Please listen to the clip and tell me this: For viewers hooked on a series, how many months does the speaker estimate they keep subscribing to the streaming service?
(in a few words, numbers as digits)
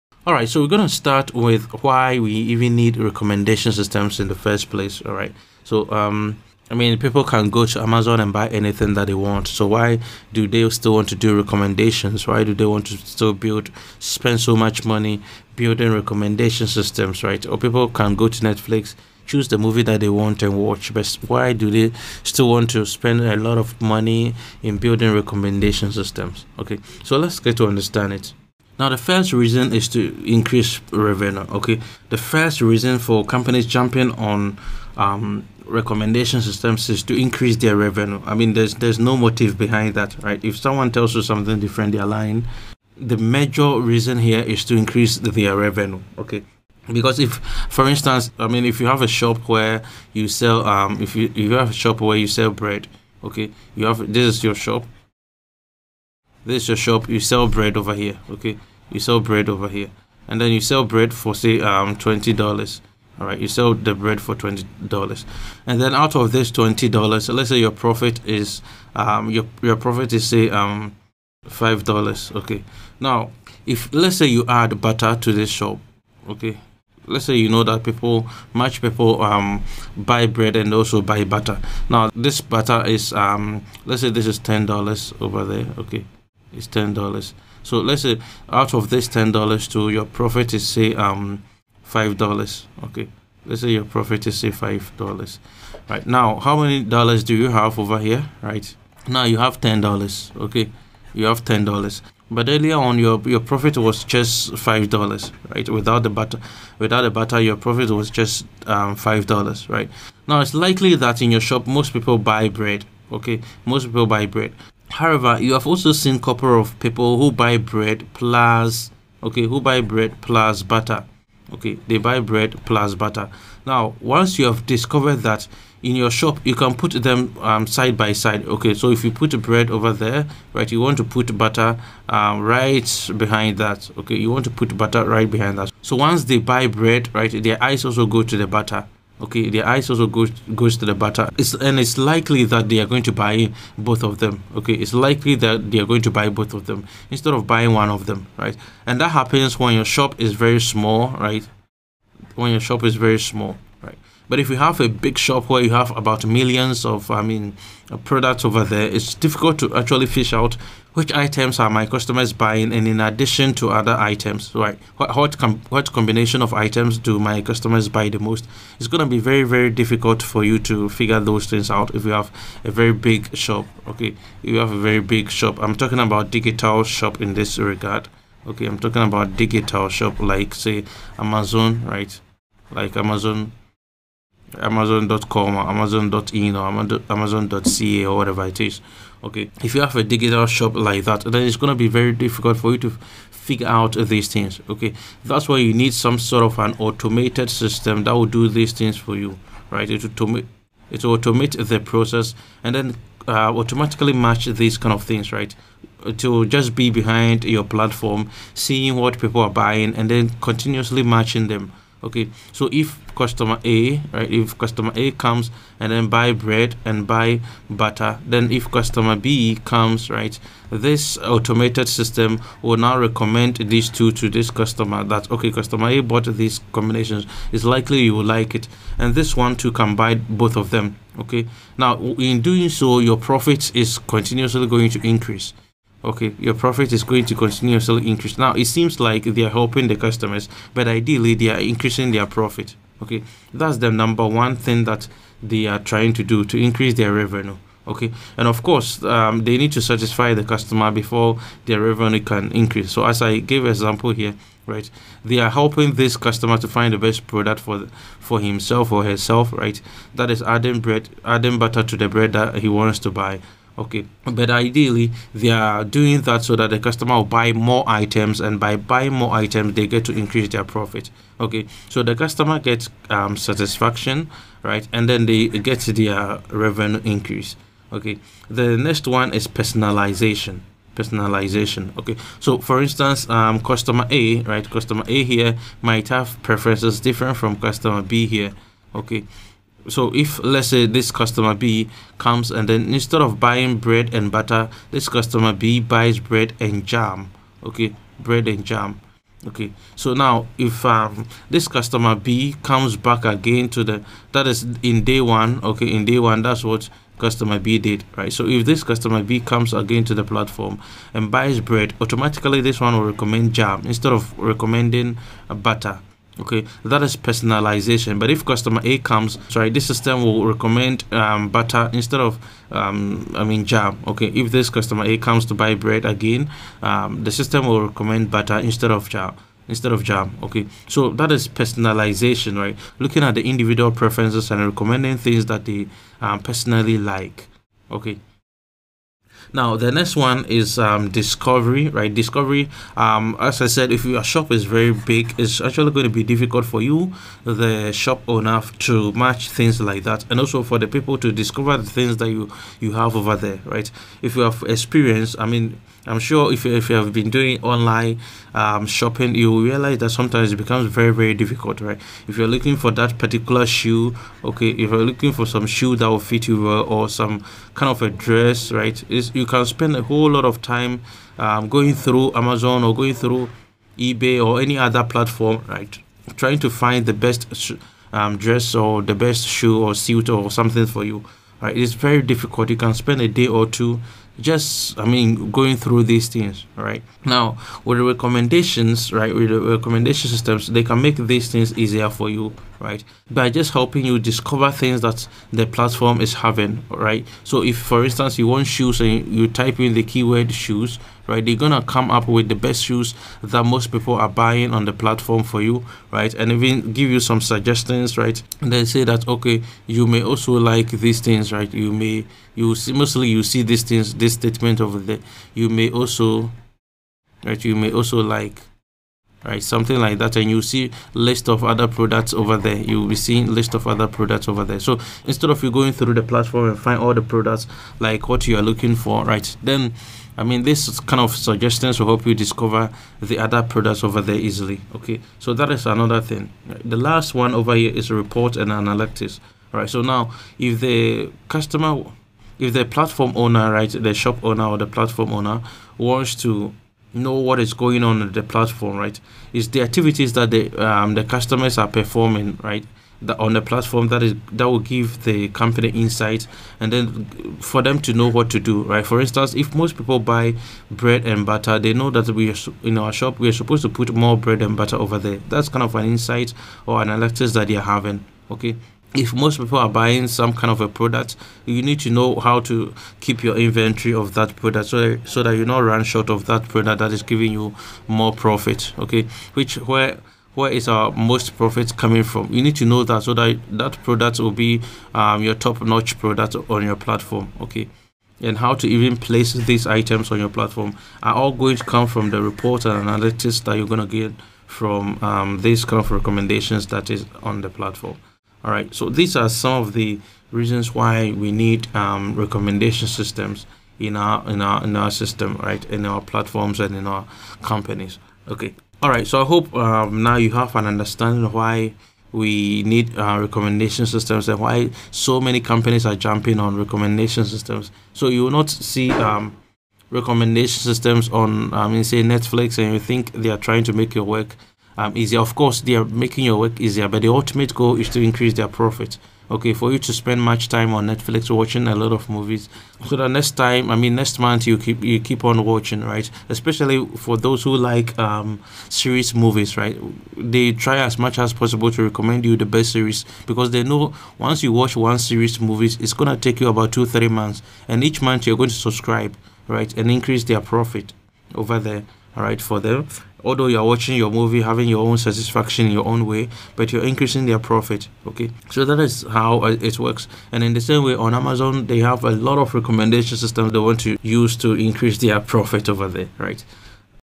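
2-3 months.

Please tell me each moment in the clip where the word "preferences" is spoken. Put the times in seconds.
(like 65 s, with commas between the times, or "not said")
286 s, 333 s.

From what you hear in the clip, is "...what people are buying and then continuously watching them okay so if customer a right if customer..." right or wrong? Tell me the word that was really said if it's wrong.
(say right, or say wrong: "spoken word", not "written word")
wrong: "matching", not "watching".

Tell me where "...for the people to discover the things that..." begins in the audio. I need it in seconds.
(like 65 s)
350 s.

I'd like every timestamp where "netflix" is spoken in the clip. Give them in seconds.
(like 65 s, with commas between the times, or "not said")
18 s, 522 s, 531 s.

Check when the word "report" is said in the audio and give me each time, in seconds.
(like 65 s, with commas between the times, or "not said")
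438 s, 492 s.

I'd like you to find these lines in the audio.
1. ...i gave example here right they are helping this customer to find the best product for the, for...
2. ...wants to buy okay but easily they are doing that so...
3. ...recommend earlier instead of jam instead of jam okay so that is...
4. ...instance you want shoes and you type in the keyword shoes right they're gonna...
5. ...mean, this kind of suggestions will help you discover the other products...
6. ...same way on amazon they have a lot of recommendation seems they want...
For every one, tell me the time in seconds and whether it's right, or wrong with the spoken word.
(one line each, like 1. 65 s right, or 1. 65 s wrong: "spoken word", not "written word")
1. 253 s right
2. 262 s wrong: "ideally", not "easily"
3. 327 s wrong: "butter", not "earlier"
4. 398 s right
5. 430 s right
6. 560 s wrong: "systems", not "seems".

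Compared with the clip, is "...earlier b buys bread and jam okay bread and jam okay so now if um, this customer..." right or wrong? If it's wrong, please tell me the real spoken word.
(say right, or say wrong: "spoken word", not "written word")
wrong: "customer", not "earlier".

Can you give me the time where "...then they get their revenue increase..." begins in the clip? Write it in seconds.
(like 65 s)
275 s.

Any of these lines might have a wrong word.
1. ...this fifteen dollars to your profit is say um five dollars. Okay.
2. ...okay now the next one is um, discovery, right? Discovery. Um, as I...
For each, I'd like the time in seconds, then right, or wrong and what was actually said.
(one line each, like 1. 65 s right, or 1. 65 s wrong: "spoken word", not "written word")
1. 88 s wrong: "ten", not "fifteen"
2. 337 s right.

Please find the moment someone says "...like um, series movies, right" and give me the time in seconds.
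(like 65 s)
537 s.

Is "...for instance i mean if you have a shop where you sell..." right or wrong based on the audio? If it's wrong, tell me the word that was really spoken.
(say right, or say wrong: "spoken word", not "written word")
right.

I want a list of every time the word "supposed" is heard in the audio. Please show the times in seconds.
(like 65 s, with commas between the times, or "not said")
463 s.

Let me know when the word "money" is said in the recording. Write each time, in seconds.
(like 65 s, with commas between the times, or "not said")
14 s, 23 s.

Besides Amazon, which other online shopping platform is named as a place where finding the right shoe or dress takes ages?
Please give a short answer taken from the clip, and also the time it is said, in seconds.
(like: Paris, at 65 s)
eBay, at 373 s.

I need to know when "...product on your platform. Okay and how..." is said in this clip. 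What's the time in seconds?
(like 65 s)
486 s.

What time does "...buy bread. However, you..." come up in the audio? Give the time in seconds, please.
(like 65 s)
114 s.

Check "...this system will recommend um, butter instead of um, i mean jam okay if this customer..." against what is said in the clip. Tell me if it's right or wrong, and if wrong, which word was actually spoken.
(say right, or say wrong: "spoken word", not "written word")
right.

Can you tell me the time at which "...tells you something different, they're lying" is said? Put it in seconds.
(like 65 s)
40 s.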